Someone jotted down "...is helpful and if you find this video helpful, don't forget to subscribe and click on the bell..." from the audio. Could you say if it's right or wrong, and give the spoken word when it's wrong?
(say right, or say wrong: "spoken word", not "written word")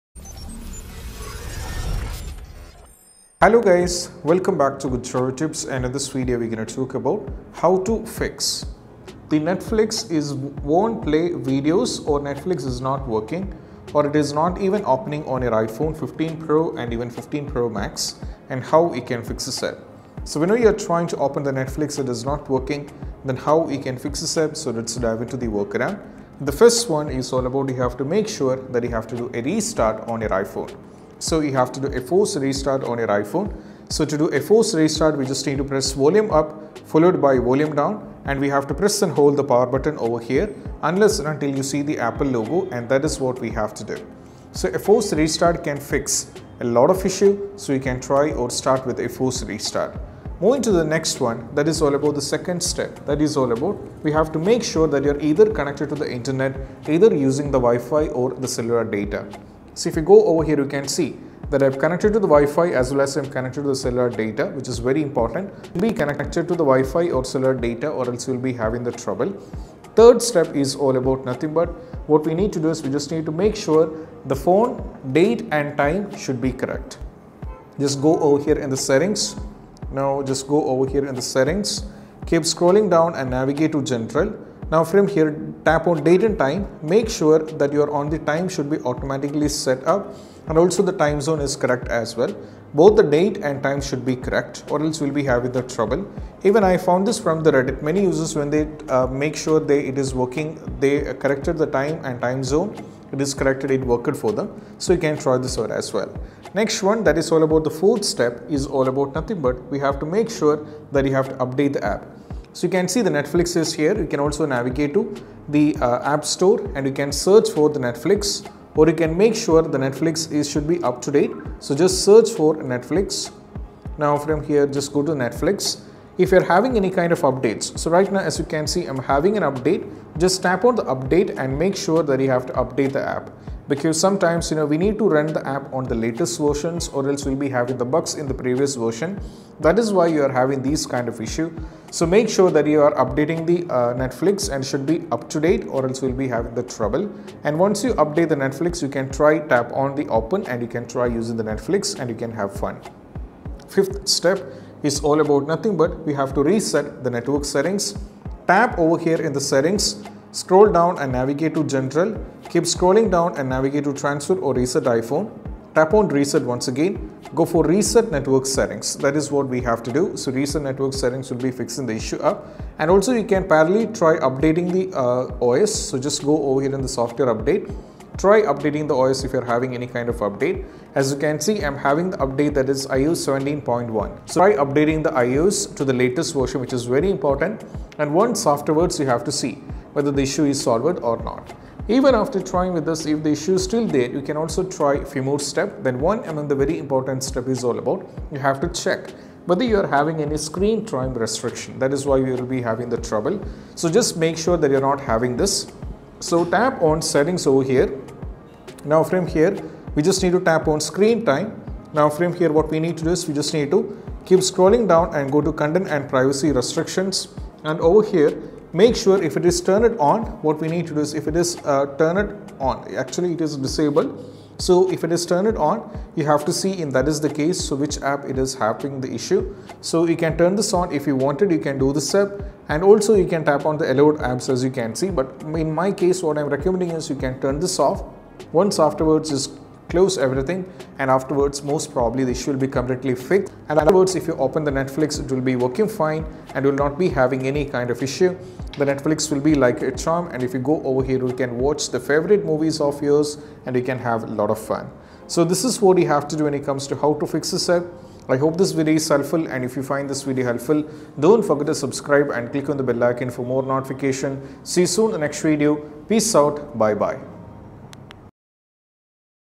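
right.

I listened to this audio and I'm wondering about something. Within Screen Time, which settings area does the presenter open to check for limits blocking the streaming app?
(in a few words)
Content and privacy restrictions.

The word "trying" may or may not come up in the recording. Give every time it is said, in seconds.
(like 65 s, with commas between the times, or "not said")
20 s, 192 s.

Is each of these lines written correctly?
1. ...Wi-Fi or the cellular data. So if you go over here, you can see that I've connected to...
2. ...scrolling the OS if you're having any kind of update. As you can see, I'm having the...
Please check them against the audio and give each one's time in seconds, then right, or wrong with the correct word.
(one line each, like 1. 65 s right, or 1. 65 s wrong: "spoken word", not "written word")
1. 57 s right
2. 178 s wrong: "updating", not "scrolling".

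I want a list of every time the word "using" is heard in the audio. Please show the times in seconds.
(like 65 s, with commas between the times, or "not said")
57 s, 151 s.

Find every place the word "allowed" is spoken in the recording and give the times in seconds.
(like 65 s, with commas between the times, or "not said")
233 s.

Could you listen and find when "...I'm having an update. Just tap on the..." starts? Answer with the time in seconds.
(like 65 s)
128 s.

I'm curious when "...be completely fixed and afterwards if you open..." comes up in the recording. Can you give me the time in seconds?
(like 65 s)
242 s.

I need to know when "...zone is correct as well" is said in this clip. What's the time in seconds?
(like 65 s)
91 s.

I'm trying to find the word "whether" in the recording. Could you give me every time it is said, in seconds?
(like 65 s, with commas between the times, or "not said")
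189 s, 199 s.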